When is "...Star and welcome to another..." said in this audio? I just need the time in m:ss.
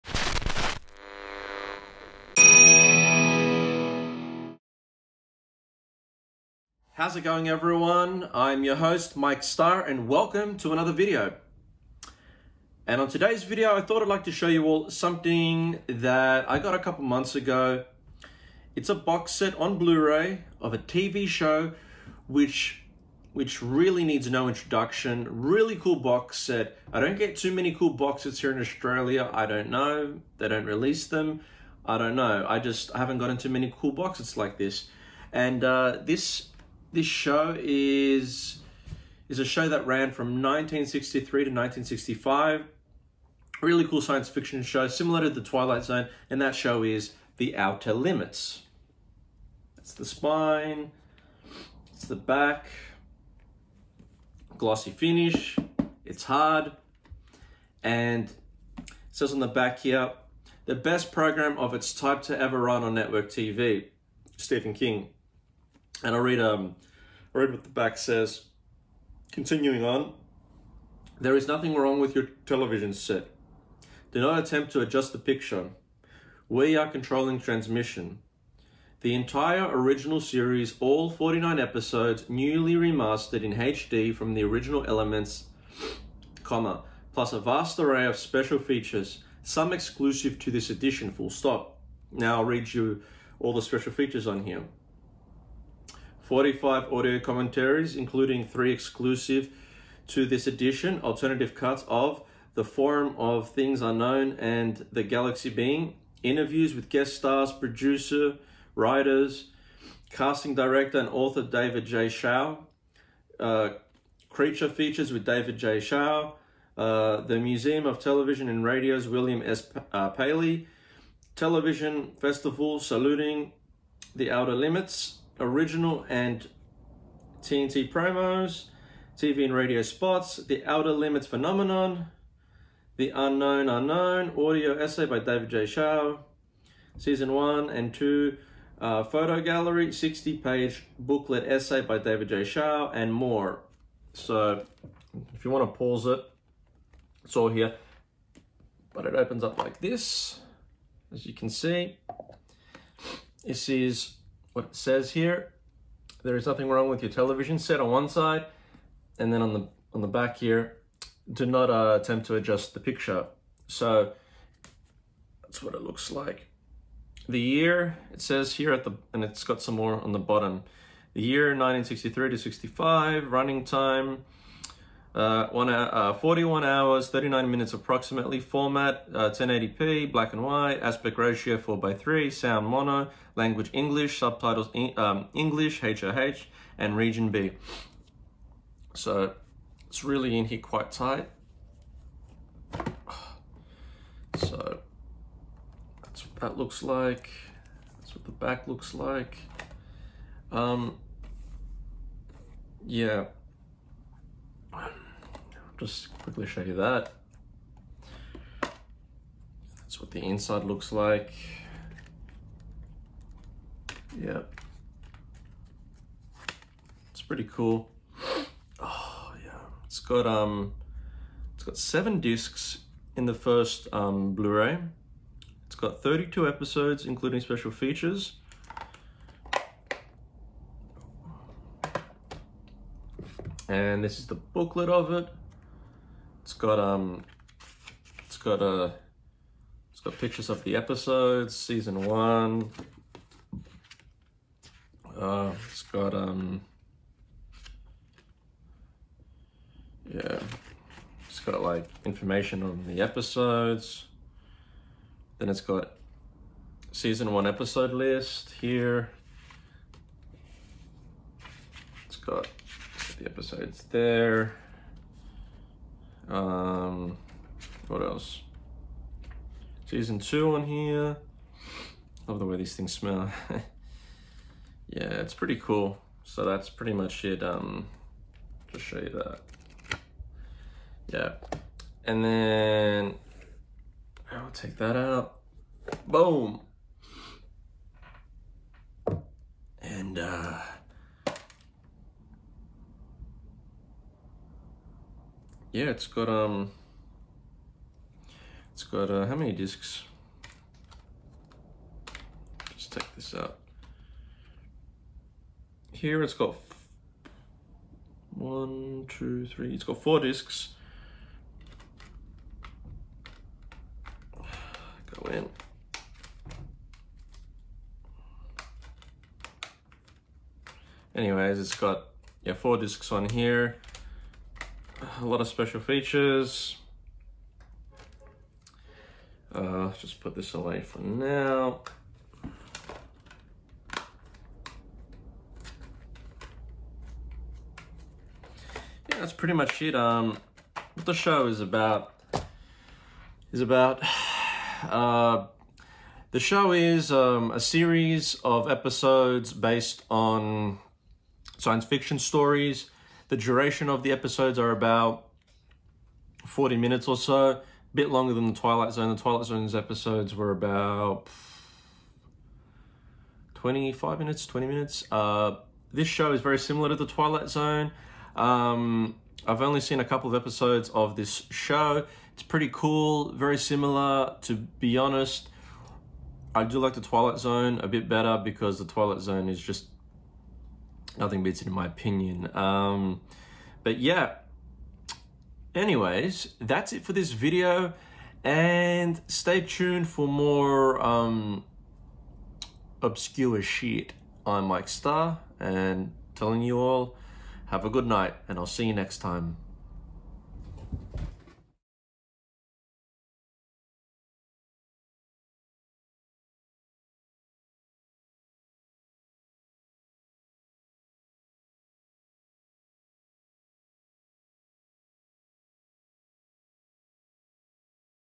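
0:09.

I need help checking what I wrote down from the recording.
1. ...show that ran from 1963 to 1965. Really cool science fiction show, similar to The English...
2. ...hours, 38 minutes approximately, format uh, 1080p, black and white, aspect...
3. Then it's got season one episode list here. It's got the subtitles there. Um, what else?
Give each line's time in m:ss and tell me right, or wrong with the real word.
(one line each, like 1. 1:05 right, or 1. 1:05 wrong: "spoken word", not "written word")
1. 0:39 wrong: "Twilight", not "English"
2. 2:56 wrong: "39", not "38"
3. 4:15 wrong: "episodes", not "subtitles".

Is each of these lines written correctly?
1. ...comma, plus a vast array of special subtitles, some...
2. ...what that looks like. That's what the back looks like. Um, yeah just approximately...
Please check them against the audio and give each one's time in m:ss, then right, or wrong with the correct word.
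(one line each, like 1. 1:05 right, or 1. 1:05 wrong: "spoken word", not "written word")
1. 1:26 wrong: "features", not "subtitles"
2. 3:16 wrong: "quickly", not "approximately".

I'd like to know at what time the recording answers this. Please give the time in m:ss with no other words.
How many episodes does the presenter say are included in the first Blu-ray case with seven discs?
3:46.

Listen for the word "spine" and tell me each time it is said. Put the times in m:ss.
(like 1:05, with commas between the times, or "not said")
0:50.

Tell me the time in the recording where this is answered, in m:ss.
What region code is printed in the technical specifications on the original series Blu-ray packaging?
3:06.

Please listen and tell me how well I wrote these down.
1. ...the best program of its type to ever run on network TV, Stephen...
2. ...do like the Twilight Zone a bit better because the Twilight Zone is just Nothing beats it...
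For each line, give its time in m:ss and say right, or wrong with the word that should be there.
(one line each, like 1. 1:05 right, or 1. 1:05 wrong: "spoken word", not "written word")
1. 1:00 right
2. 6:16 right.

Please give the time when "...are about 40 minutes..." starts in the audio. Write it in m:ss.
5:54.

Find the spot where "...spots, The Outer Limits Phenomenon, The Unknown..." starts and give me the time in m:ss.
2:09.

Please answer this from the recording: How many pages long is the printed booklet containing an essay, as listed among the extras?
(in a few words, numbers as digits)
60.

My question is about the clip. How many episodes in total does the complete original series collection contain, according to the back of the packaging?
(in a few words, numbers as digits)
49.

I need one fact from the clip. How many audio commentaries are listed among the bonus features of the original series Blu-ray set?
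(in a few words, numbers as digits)
45.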